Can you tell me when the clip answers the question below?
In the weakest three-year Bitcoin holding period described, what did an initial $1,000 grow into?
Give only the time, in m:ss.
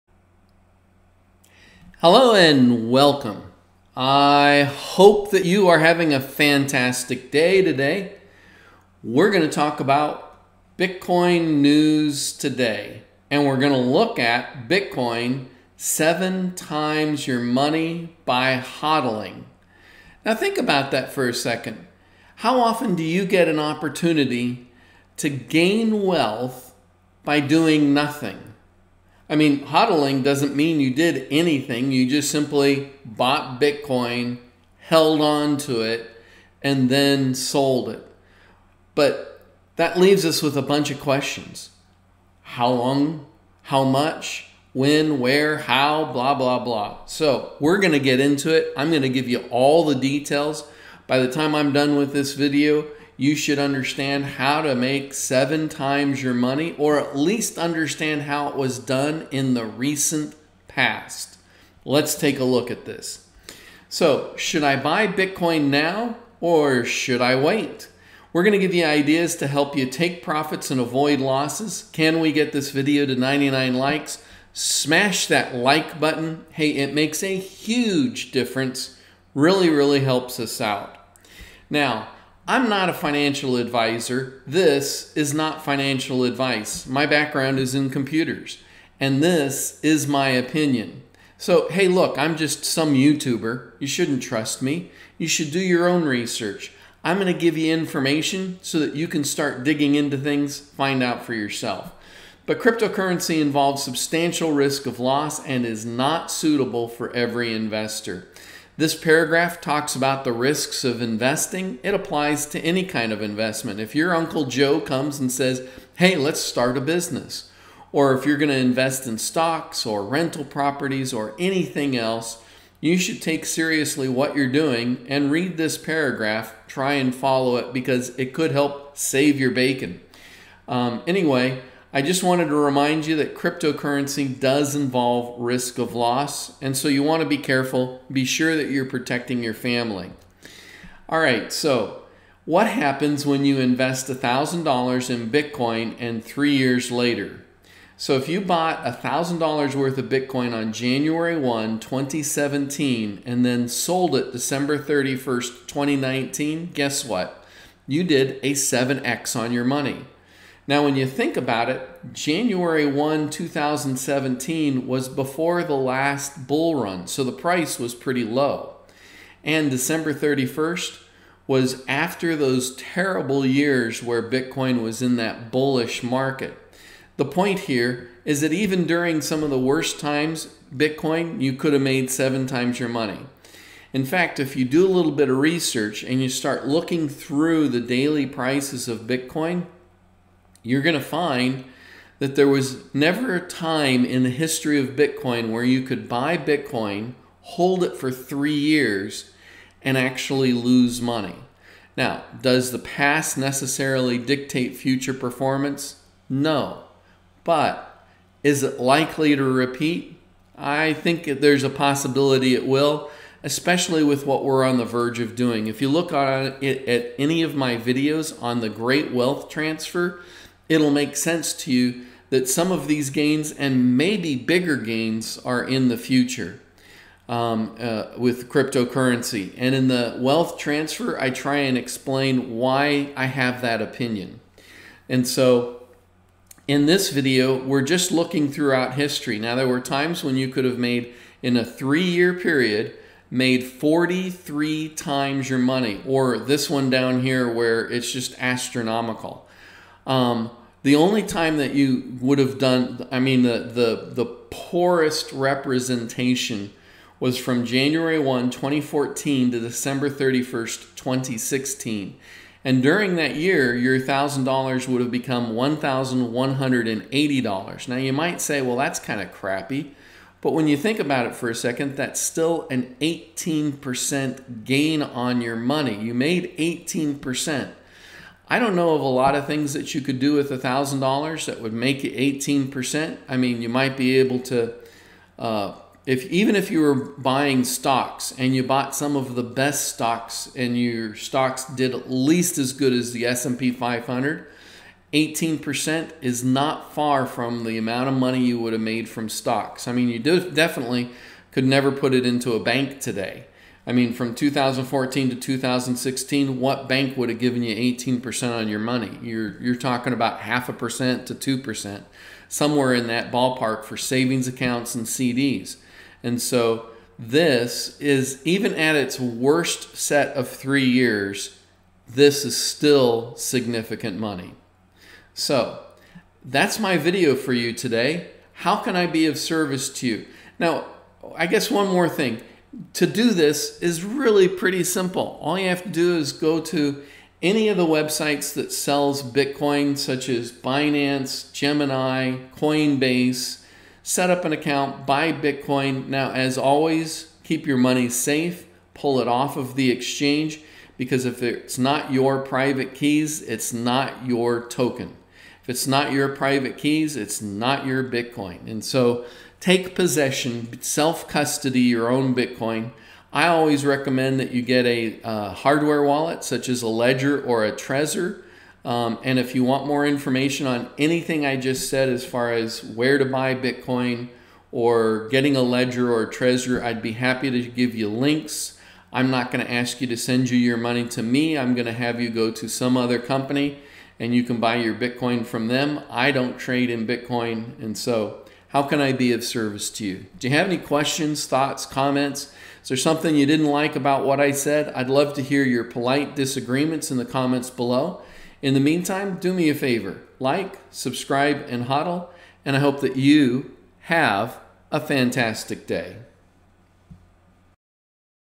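4:25.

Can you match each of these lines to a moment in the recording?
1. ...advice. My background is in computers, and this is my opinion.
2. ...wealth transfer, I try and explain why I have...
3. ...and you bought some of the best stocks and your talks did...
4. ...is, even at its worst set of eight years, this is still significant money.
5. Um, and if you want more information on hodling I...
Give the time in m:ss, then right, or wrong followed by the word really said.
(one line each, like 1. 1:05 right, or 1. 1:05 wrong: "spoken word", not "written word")
1. 1:26 right
2. 3:50 right
3. 4:48 wrong: "stocks", not "talks"
4. 5:17 wrong: "three", not "eight"
5. 6:08 wrong: "anything", not "hodling".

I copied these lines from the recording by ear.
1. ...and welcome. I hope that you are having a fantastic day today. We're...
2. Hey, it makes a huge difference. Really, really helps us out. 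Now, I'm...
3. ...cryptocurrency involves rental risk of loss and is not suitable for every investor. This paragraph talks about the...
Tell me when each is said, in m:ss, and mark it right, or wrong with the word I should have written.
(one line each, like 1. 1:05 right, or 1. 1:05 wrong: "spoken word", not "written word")
1. 0:02 right
2. 1:16 right
3. 1:42 wrong: "substantial", not "rental".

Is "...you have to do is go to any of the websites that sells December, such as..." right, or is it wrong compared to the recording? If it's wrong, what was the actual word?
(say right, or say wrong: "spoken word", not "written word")
wrong: "Bitcoin", not "December".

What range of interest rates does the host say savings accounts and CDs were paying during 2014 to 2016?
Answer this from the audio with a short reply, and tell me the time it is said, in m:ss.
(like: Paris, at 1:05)
Half a percent to 2%, at 5:10.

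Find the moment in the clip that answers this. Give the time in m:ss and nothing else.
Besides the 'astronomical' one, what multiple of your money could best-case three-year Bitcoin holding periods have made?
4:03.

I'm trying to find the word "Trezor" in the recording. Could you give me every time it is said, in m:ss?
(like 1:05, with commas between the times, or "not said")
6:07, 6:16.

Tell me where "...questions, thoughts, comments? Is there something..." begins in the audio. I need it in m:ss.
6:30.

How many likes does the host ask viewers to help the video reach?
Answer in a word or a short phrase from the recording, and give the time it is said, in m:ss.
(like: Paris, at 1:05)
99, at 1:13.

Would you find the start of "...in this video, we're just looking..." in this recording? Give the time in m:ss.
3:56.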